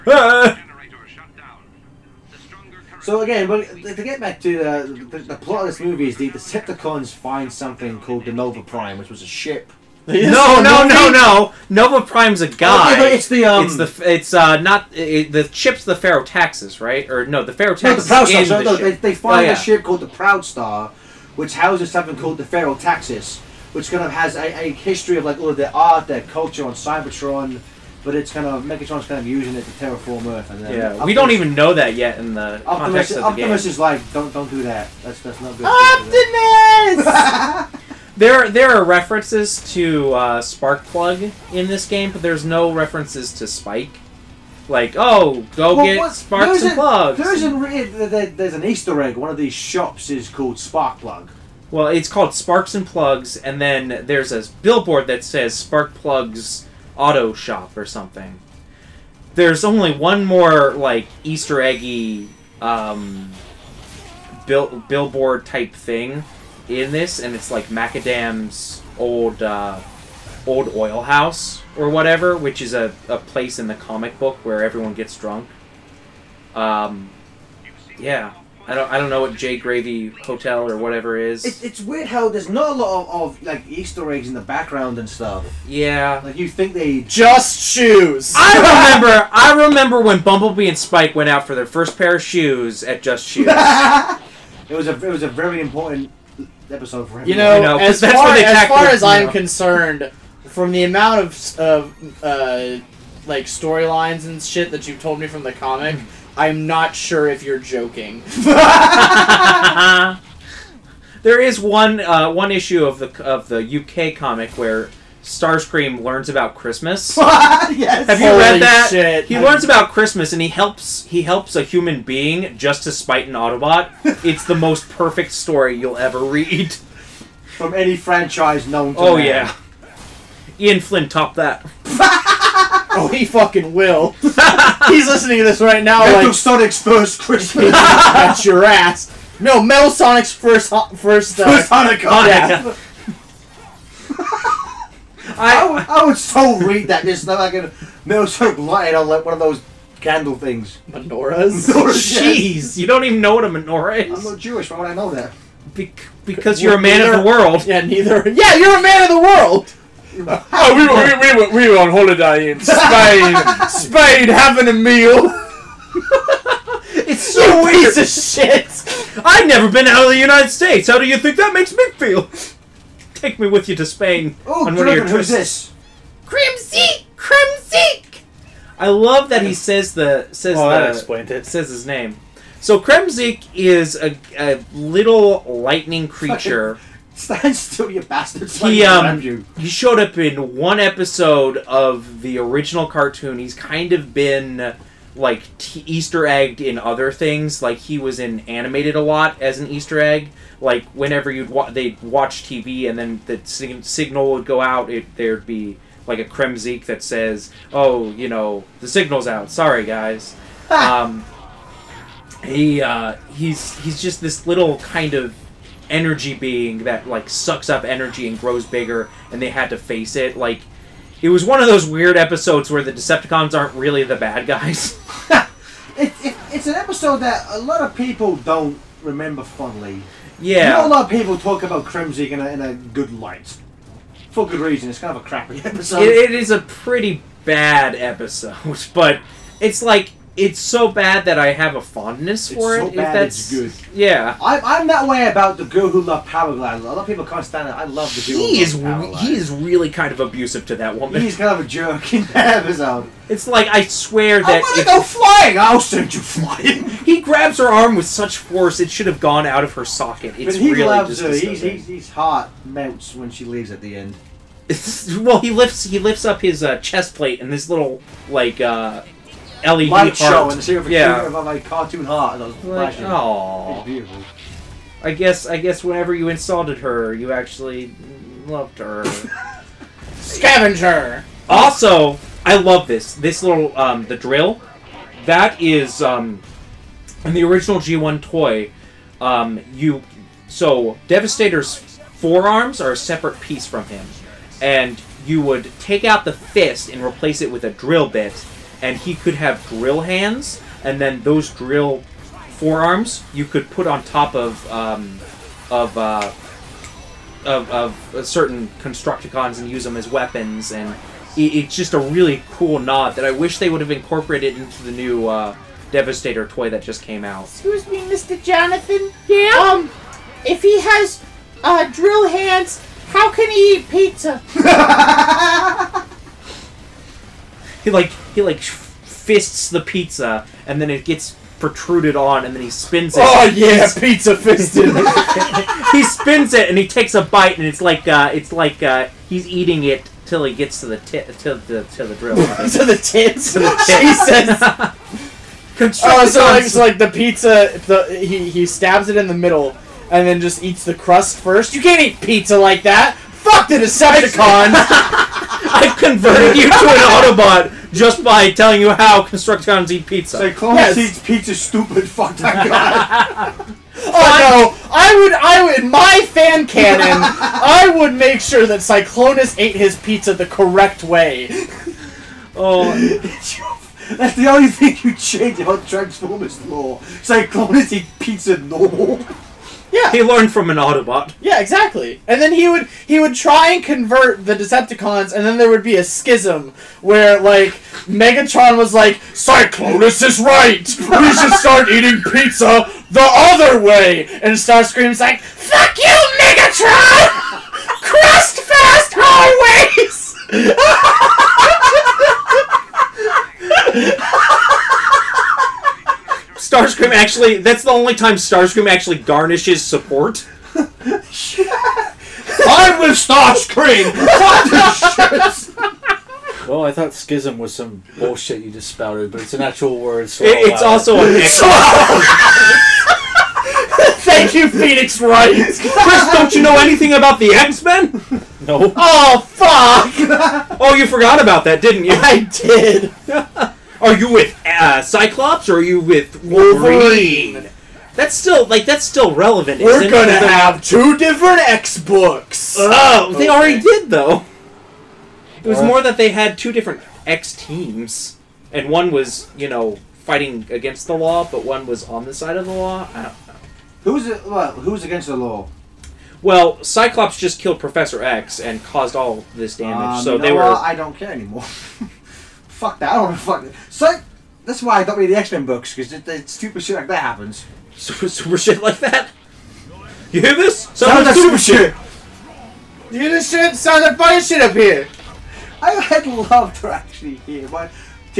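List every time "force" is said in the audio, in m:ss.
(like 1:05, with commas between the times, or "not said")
4:18.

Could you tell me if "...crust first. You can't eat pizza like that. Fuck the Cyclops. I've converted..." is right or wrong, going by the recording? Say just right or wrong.
wrong.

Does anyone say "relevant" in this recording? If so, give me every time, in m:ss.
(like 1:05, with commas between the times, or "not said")
7:19.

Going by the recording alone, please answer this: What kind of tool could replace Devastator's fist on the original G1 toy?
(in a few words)
drill bit.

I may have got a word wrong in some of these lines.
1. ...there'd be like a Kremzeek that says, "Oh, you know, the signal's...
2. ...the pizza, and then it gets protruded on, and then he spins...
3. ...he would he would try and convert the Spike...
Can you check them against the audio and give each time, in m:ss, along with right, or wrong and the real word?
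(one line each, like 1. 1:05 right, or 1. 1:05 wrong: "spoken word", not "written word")
1. 3:25 right
2. 5:29 right
3. 6:22 wrong: "Decepticons", not "Spike".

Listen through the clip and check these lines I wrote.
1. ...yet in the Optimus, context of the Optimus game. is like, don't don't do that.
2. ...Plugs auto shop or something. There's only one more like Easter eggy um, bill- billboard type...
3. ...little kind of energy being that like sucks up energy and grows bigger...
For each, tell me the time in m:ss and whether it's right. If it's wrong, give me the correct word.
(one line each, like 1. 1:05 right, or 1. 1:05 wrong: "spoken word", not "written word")
1. 0:31 right
2. 0:55 right
3. 3:34 right.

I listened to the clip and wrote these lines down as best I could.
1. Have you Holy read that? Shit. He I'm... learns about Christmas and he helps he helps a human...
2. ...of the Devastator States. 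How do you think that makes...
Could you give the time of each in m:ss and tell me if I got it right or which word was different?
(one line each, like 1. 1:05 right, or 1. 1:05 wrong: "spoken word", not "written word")
1. 1:58 right
2. 2:50 wrong: "United", not "Devastator".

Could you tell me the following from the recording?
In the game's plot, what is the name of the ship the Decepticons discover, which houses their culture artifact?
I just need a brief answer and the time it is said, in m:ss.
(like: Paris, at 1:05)
Proud Star, at 0:20.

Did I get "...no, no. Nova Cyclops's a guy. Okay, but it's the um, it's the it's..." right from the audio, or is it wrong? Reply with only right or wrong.
wrong.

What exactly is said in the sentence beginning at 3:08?
He um, he showed up in one episode of the original cartoon.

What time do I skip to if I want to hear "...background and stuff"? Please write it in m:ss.
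1:24.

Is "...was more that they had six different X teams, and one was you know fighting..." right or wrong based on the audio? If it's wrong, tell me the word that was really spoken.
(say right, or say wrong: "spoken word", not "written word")
wrong: "two", not "six".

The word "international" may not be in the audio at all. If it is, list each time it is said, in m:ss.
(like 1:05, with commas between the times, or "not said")
not said.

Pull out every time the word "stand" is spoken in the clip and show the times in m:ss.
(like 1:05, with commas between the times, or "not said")
3:07, 4:07.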